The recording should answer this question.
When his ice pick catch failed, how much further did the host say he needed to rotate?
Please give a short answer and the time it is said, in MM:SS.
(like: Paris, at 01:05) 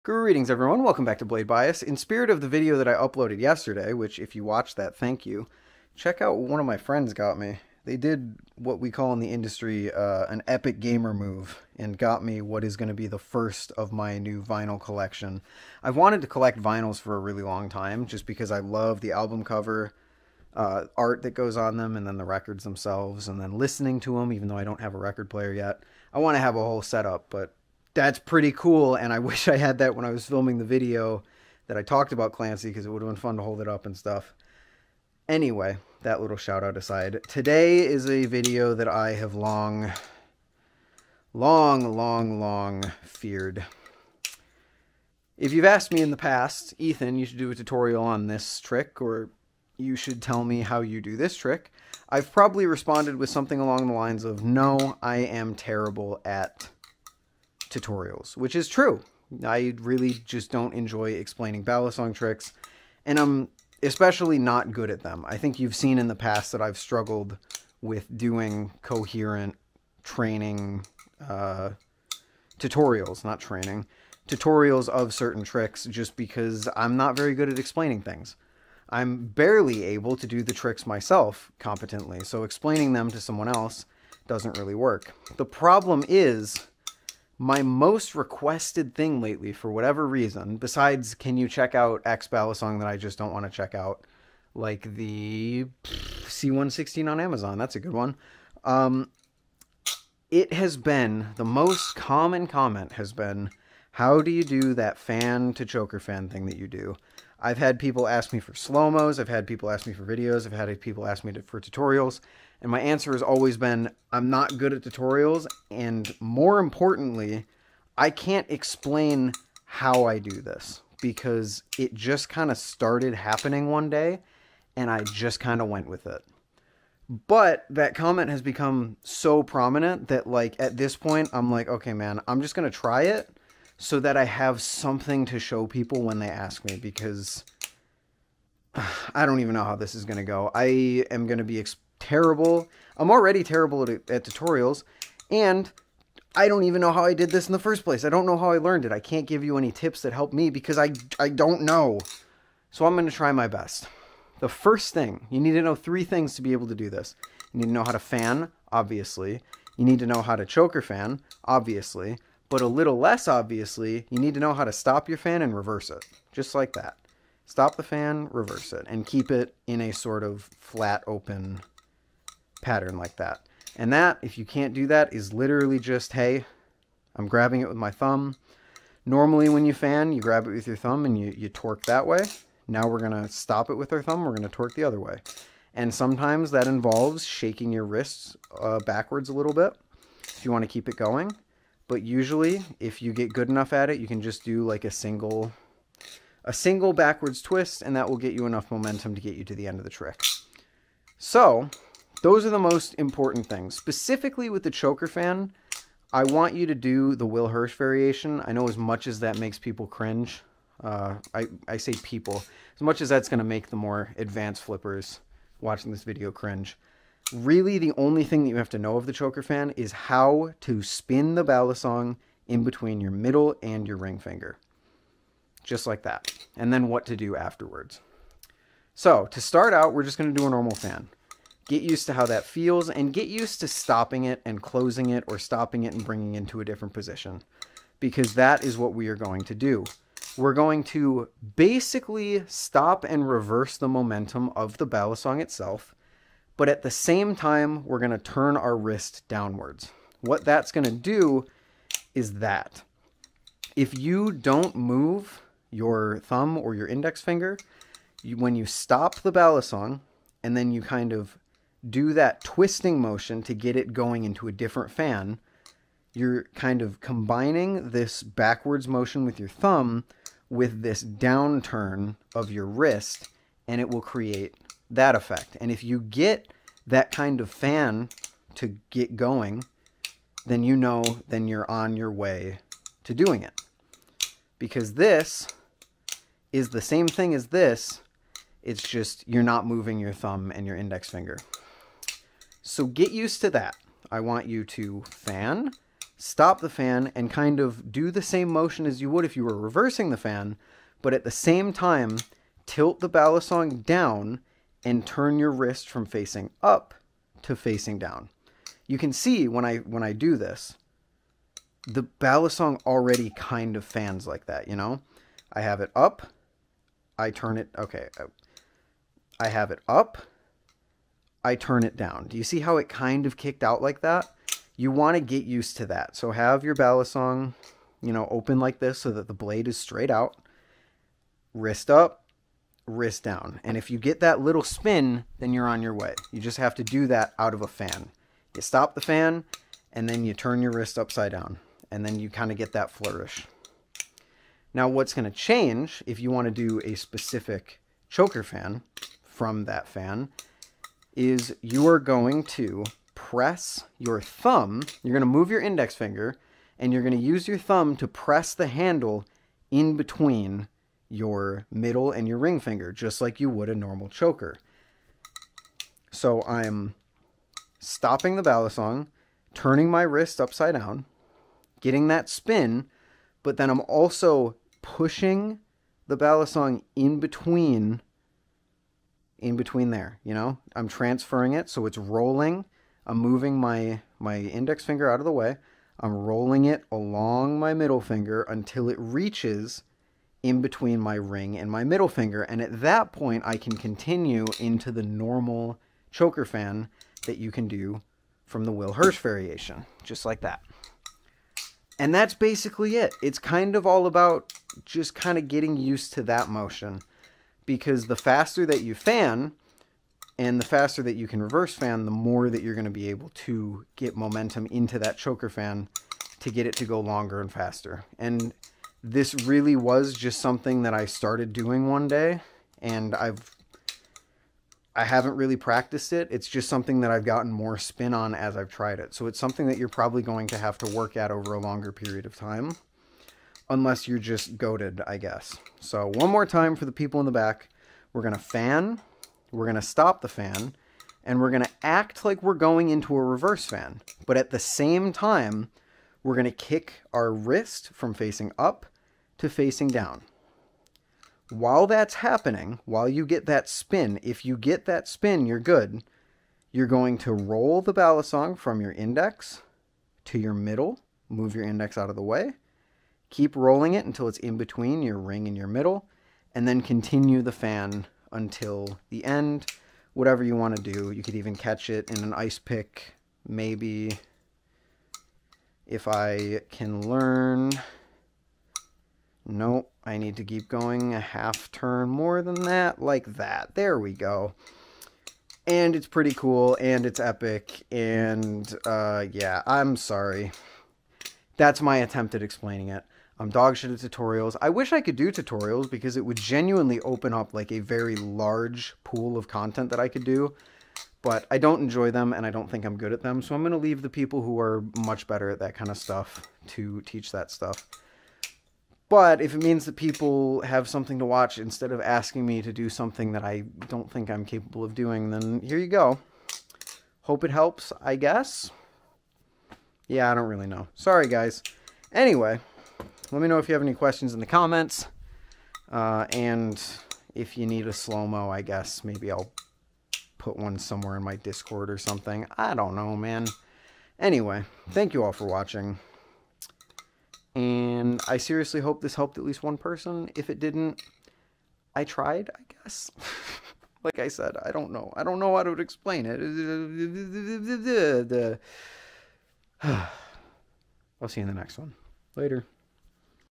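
A half turn, at 08:01.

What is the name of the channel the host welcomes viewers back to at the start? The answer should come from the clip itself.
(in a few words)
Blade Bias.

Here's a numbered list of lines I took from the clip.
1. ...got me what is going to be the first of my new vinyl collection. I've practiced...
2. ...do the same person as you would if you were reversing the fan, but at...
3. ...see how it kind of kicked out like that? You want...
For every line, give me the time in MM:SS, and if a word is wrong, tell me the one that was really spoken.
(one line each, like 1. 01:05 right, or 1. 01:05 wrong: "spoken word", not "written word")
1. 00:11 wrong: "wanted", not "practiced"
2. 04:57 wrong: "motion", not "person"
3. 05:22 right.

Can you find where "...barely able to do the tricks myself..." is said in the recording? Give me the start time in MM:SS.
01:19.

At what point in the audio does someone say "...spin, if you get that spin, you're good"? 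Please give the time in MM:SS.
07:33.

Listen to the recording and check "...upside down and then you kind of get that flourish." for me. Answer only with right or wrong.
right.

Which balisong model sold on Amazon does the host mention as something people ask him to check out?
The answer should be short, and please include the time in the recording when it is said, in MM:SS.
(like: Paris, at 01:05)
C116, at 01:35.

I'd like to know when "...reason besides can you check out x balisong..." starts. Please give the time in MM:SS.
01:30.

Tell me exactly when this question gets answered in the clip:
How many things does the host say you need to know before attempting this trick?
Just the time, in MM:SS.
02:35.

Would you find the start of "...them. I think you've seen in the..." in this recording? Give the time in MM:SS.
01:05.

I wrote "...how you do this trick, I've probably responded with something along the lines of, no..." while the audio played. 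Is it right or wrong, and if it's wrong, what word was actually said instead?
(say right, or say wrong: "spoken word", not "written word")
right.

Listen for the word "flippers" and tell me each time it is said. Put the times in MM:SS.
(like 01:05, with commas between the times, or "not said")
03:34.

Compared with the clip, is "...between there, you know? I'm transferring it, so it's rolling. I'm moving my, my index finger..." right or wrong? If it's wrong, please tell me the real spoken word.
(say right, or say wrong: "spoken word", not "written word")
right.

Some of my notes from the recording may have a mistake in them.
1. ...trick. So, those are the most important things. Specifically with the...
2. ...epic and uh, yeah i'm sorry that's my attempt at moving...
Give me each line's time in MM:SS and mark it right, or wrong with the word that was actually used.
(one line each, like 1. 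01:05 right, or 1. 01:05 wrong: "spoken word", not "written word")
1. 03:19 right
2. 08:07 wrong: "explaining", not "moving".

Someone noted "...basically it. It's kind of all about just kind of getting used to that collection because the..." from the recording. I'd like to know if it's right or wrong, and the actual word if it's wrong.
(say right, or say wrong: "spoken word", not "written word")
wrong: "motion", not "collection".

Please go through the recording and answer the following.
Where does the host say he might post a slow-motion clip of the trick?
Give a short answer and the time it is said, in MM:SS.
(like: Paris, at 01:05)
Discord, at 08:51.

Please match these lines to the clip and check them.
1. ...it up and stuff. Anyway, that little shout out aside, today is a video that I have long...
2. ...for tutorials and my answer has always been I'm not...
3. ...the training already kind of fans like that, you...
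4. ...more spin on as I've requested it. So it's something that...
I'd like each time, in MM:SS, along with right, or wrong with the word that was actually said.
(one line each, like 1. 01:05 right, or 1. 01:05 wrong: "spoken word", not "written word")
1. 00:33 right
2. 01:51 right
3. 05:11 wrong: "balisong", not "training"
4. 07:07 wrong: "tried", not "requested".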